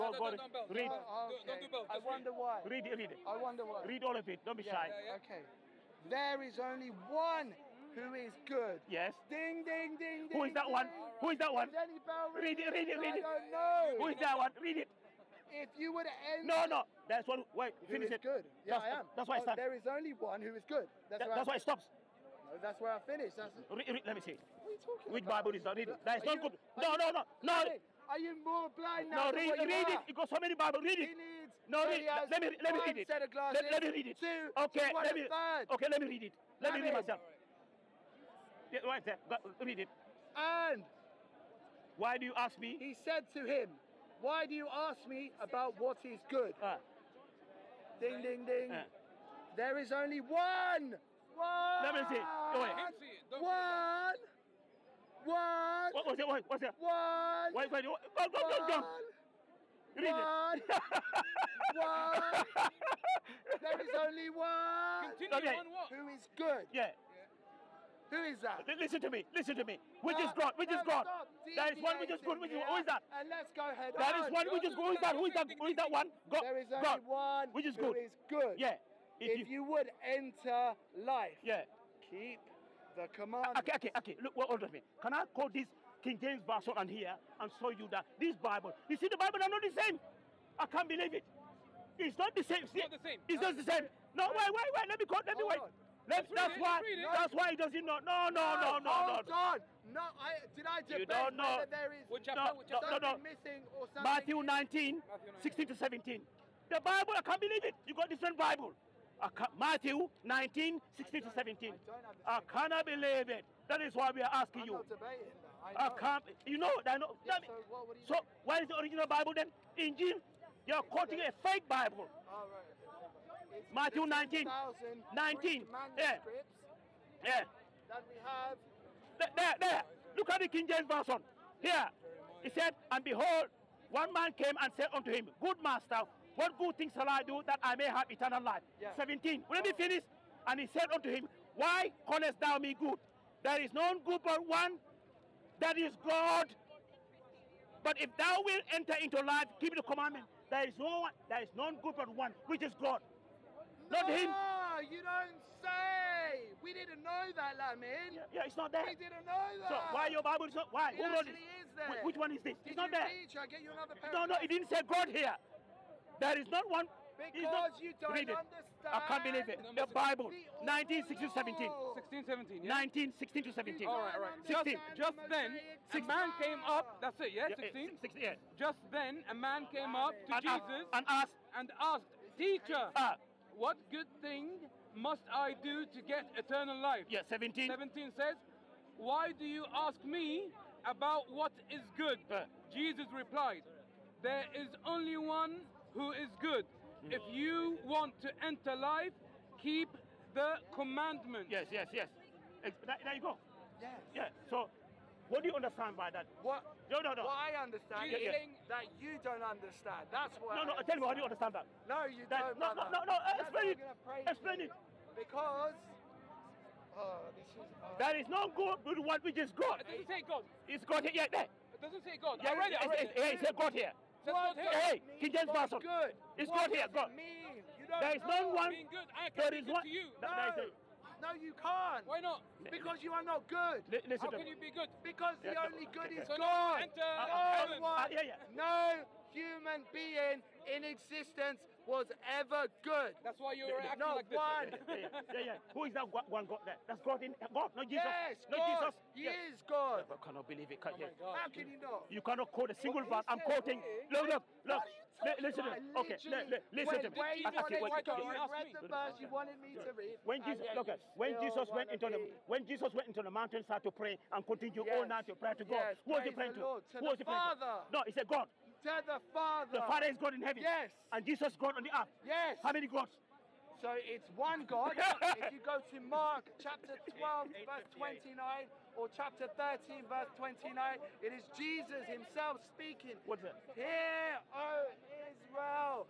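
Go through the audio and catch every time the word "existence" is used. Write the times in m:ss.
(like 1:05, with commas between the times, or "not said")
4:00.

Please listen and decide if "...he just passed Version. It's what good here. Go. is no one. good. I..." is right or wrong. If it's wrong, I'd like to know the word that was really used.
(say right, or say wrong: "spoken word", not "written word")
wrong: "Good", not "Version".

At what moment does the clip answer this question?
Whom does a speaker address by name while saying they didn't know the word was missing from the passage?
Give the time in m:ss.
2:37.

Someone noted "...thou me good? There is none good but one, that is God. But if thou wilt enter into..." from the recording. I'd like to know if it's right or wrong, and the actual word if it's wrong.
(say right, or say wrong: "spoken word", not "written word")
right.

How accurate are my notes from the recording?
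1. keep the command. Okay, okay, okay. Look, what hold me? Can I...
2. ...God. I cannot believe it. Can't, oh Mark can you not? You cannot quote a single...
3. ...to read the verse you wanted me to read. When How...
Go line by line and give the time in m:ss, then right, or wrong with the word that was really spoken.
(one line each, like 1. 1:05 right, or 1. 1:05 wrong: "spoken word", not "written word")
1. 1:22 right
2. 4:09 wrong: "How", not "Mark"
3. 4:17 wrong: "Jesus", not "How".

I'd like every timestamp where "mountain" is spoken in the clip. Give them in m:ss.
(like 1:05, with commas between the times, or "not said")
4:23.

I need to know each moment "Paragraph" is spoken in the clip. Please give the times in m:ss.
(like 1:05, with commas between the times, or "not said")
2:43.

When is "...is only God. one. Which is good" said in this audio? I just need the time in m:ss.
1:16.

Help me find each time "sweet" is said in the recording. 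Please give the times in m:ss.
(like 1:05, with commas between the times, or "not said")
not said.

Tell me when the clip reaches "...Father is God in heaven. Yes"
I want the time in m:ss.
4:29.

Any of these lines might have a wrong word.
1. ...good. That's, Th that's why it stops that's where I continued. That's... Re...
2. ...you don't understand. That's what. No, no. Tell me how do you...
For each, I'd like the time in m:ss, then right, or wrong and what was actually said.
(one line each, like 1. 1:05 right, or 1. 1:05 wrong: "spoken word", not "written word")
1. 0:20 wrong: "finished", not "continued"
2. 3:28 right.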